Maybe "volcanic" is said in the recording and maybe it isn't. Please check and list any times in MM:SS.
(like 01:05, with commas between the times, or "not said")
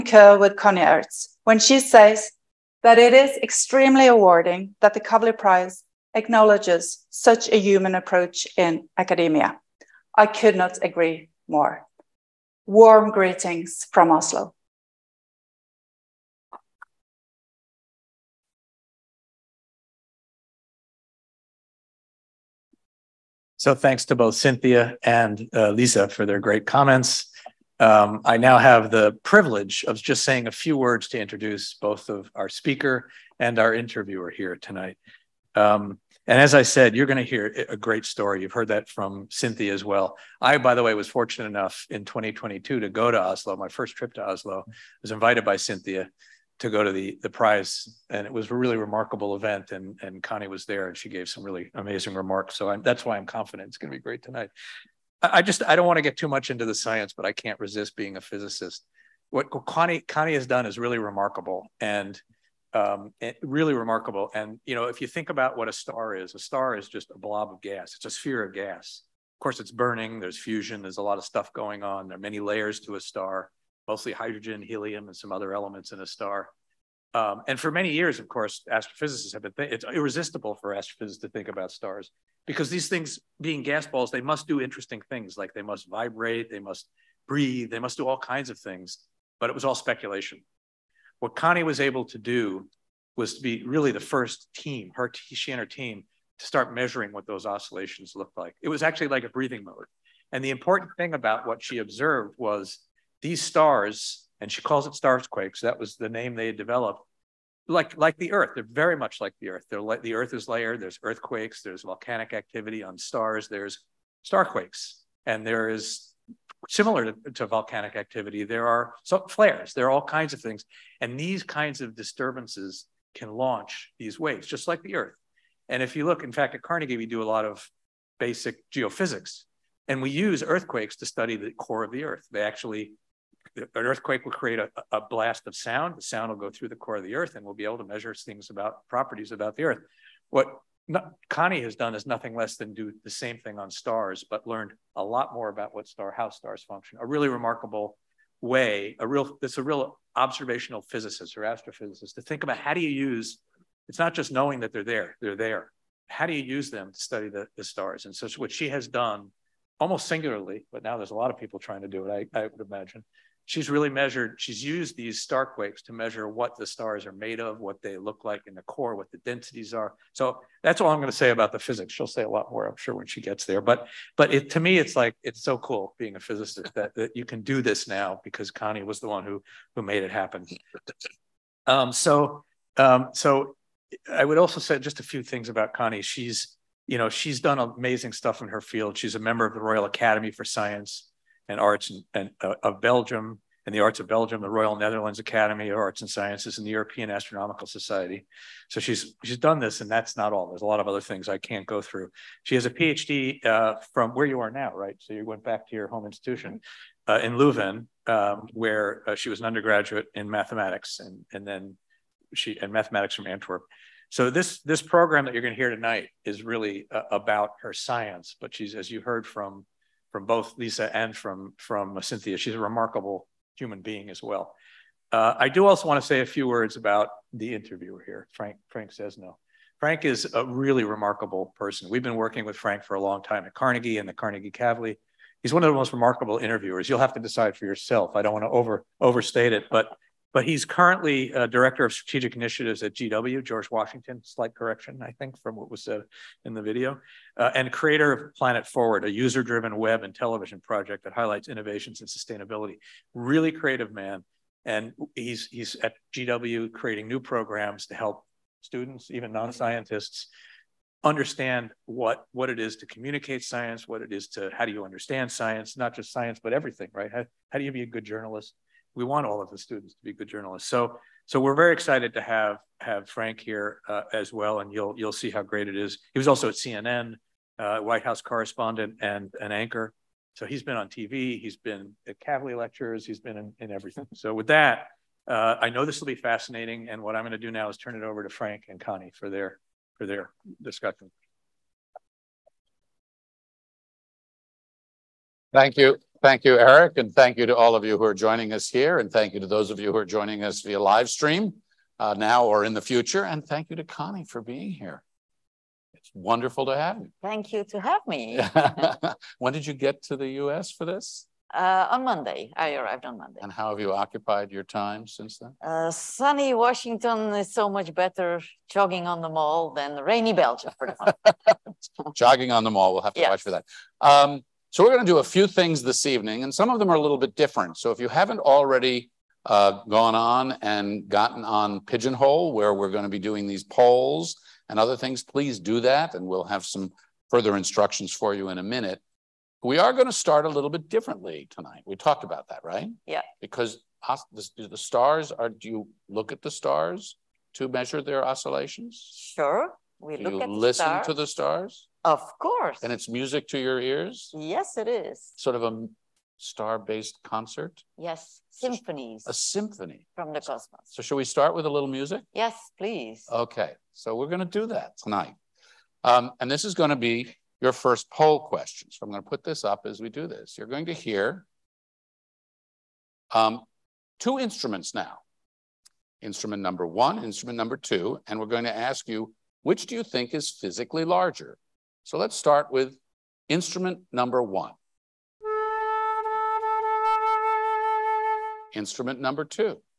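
01:51, 01:57.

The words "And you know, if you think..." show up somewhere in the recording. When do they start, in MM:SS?
01:04.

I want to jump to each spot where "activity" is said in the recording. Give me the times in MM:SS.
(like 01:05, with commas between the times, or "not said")
01:52, 01:57.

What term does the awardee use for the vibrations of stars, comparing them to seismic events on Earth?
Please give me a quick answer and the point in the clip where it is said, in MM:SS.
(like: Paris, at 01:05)
starsquakes, at 01:44.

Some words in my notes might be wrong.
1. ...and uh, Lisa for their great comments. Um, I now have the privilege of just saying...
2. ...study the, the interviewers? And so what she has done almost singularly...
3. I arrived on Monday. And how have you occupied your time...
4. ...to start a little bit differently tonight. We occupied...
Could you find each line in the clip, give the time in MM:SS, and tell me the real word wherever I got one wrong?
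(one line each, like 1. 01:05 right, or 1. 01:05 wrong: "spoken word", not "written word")
1. 00:25 right
2. 02:36 wrong: "stars", not "interviewers"
3. 05:12 right
4. 05:40 wrong: "talked", not "occupied".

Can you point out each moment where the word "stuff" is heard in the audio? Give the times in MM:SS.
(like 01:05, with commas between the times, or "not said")
01:11, 03:08.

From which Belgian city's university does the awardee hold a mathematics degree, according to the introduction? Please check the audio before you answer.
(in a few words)
Antwerp.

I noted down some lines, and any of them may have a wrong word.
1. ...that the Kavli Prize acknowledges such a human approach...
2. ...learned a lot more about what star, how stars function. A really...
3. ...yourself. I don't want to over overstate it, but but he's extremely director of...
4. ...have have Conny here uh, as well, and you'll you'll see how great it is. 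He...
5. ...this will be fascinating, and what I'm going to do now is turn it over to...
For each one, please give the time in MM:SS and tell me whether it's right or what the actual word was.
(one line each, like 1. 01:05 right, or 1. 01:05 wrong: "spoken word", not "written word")
1. 00:04 right
2. 02:24 right
3. 03:57 wrong: "currently", not "extremely"
4. 04:32 wrong: "Frank", not "Conny"
5. 04:45 right.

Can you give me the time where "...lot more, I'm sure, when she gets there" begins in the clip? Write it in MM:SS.
02:52.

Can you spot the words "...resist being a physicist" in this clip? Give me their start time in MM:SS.
00:57.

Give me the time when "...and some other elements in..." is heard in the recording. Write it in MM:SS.
01:15.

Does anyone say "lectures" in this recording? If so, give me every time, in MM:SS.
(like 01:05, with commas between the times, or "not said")
04:42.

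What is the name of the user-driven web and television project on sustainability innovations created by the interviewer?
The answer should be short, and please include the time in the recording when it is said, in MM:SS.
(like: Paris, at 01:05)
Planet Forward, at 04:08.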